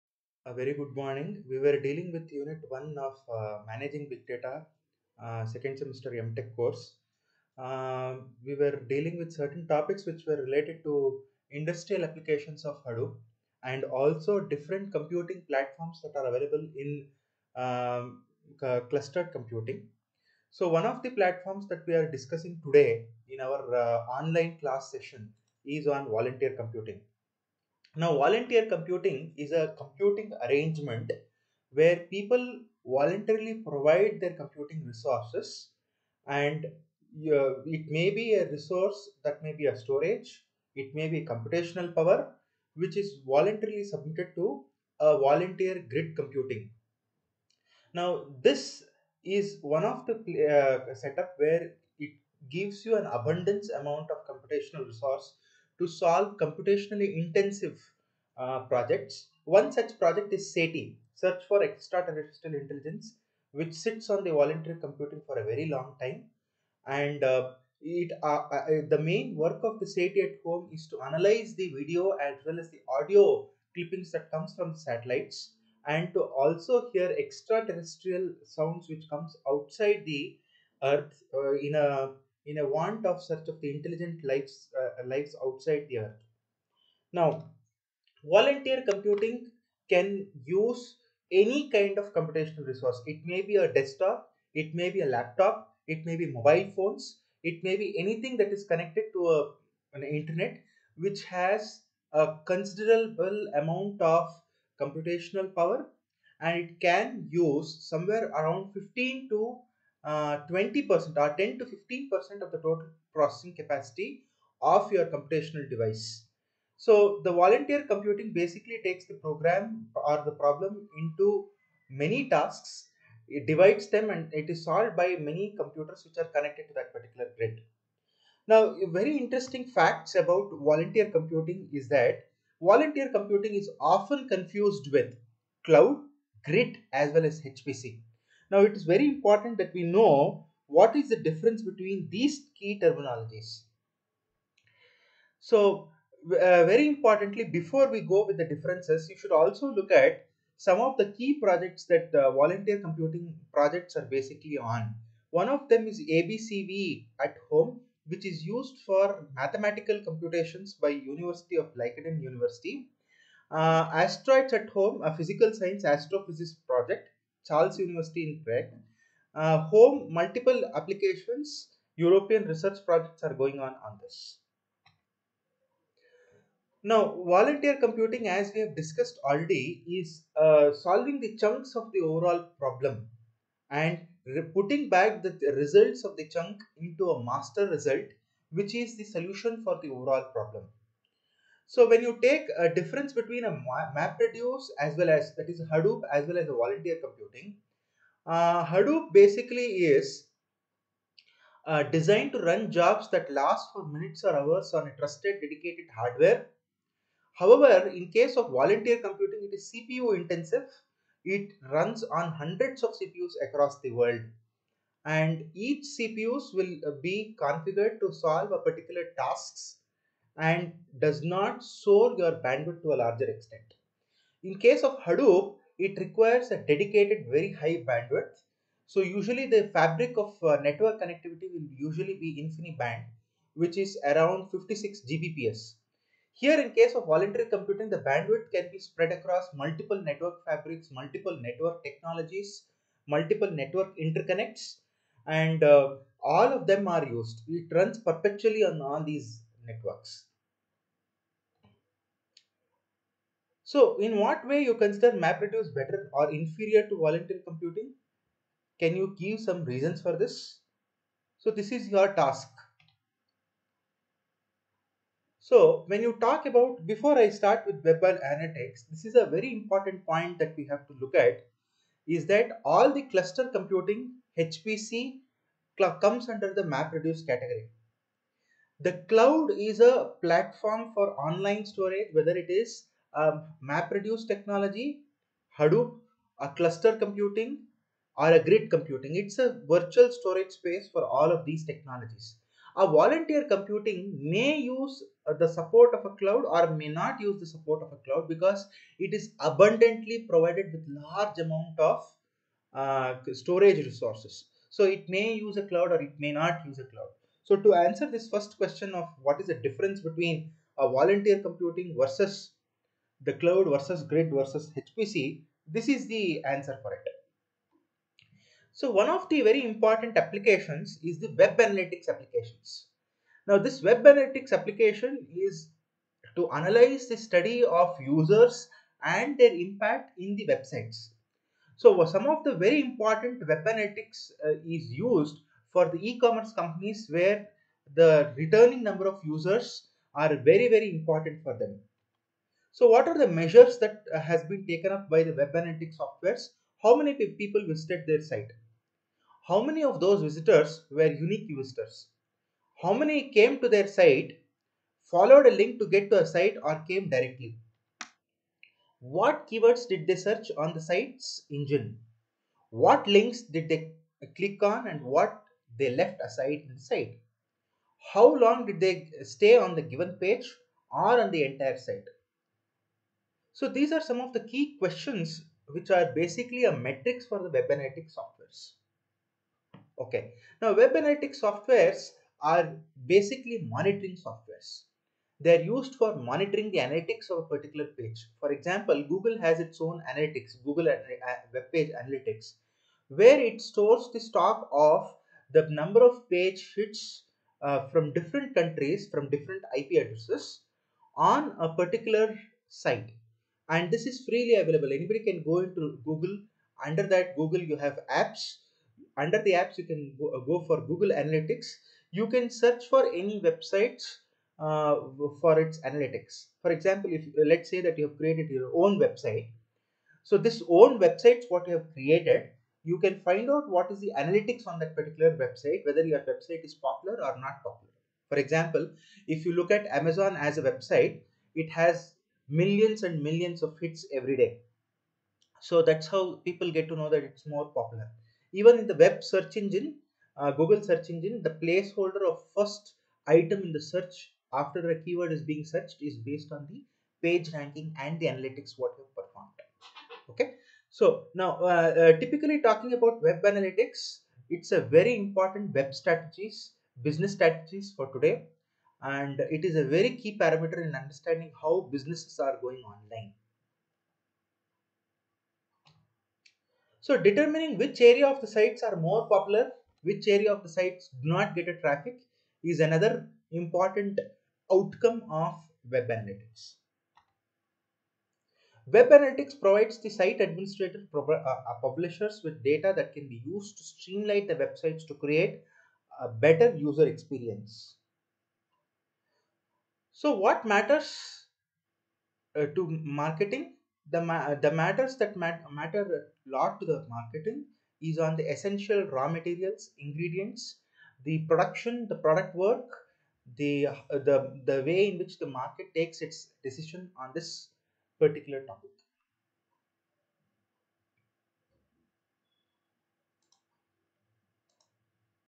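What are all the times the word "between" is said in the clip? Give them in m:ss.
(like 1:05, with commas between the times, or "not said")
2:21, 3:13, 5:09.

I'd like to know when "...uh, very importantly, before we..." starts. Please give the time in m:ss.
2:26.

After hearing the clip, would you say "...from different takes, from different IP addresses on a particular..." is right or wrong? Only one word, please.
wrong.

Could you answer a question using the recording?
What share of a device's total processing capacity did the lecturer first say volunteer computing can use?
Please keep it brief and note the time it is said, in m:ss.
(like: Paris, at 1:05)
15 to 20%, at 1:48.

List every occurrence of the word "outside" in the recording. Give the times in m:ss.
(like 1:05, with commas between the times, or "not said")
1:19, 1:25.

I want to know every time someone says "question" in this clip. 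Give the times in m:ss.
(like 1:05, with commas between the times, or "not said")
5:08, 6:14.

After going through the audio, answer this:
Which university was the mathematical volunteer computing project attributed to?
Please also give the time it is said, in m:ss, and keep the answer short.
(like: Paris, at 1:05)
Leiden University, at 2:40.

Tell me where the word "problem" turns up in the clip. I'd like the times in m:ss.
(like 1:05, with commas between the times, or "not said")
2:00, 3:02, 3:10.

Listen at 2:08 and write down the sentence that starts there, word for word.
Now very interesting facts about volunteer computing is that volunteer computing is often confused with cloud, grid as well as HPC.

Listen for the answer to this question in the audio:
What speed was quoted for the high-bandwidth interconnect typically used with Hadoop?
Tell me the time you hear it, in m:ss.
3:54.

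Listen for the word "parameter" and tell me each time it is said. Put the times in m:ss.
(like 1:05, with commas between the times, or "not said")
7:40.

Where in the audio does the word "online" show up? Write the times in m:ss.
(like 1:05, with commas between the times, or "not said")
0:24, 4:41, 7:42.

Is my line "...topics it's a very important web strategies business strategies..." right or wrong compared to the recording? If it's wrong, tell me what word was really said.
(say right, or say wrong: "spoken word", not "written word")
wrong: "analytics", not "topics".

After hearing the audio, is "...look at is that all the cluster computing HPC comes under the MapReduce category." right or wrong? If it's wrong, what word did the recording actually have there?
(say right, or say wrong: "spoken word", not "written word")
right.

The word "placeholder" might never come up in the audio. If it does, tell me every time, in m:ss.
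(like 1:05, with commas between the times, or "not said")
7:21.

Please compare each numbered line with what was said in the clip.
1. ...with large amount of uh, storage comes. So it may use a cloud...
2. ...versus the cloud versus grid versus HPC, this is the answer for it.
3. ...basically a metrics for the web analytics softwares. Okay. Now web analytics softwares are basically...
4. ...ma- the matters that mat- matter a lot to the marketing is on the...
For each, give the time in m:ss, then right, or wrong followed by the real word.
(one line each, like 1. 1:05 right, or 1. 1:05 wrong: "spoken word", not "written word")
1. 5:00 wrong: "resources", not "comes"
2. 5:11 right
3. 6:16 right
4. 8:14 right.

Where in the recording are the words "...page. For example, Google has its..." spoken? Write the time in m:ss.
6:27.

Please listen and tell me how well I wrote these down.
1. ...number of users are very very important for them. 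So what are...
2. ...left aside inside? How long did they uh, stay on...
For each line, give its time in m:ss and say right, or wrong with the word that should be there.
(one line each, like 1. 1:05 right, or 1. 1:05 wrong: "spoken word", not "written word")
1. 5:38 right
2. 6:05 right.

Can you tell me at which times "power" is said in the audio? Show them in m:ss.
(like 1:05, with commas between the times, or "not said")
0:41, 1:45.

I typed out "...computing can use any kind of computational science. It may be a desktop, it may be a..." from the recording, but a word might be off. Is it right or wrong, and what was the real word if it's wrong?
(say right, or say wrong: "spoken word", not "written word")
wrong: "resource", not "science".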